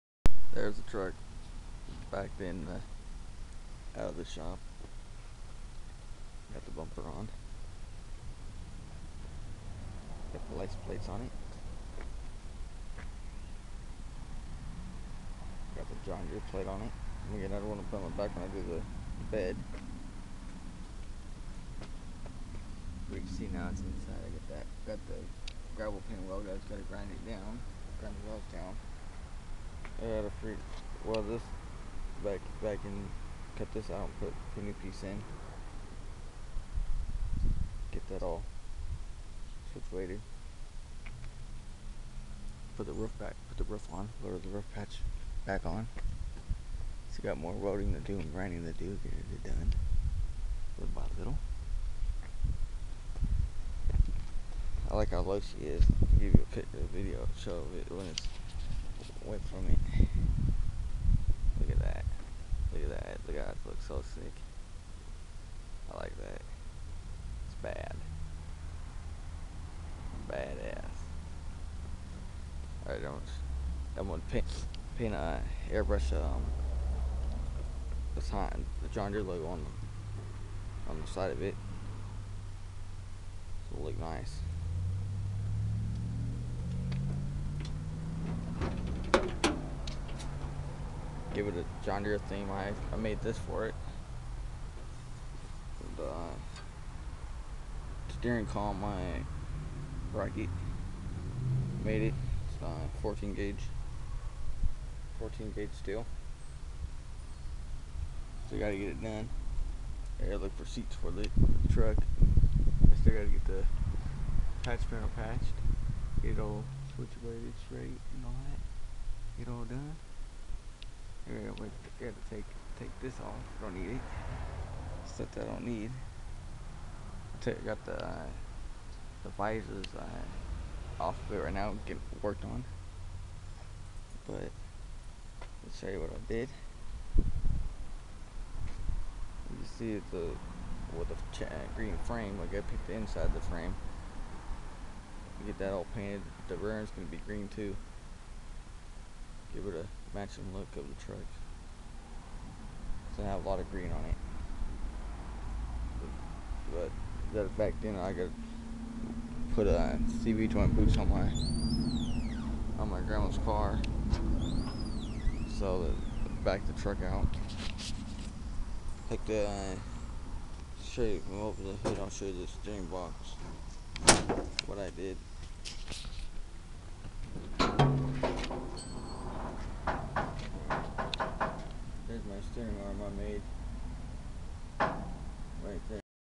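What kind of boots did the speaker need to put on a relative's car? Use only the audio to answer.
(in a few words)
CV joint boots.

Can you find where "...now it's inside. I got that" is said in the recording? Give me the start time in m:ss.
0:23.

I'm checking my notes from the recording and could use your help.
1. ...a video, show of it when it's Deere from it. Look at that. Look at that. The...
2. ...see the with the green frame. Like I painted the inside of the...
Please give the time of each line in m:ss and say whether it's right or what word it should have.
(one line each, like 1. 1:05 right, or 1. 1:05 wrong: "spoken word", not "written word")
1. 0:56 wrong: "Went", not "Deere"
2. 2:19 wrong: "picked", not "painted".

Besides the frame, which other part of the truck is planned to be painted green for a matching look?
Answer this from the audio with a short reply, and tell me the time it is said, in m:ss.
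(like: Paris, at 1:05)
The rear end, at 2:26.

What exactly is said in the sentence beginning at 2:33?
gonna have a lot of green on it.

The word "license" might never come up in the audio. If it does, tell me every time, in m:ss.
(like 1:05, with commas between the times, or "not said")
0:10.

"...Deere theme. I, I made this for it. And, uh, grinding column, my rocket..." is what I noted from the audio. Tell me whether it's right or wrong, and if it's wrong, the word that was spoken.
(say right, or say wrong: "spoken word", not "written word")
wrong: "steering", not "grinding".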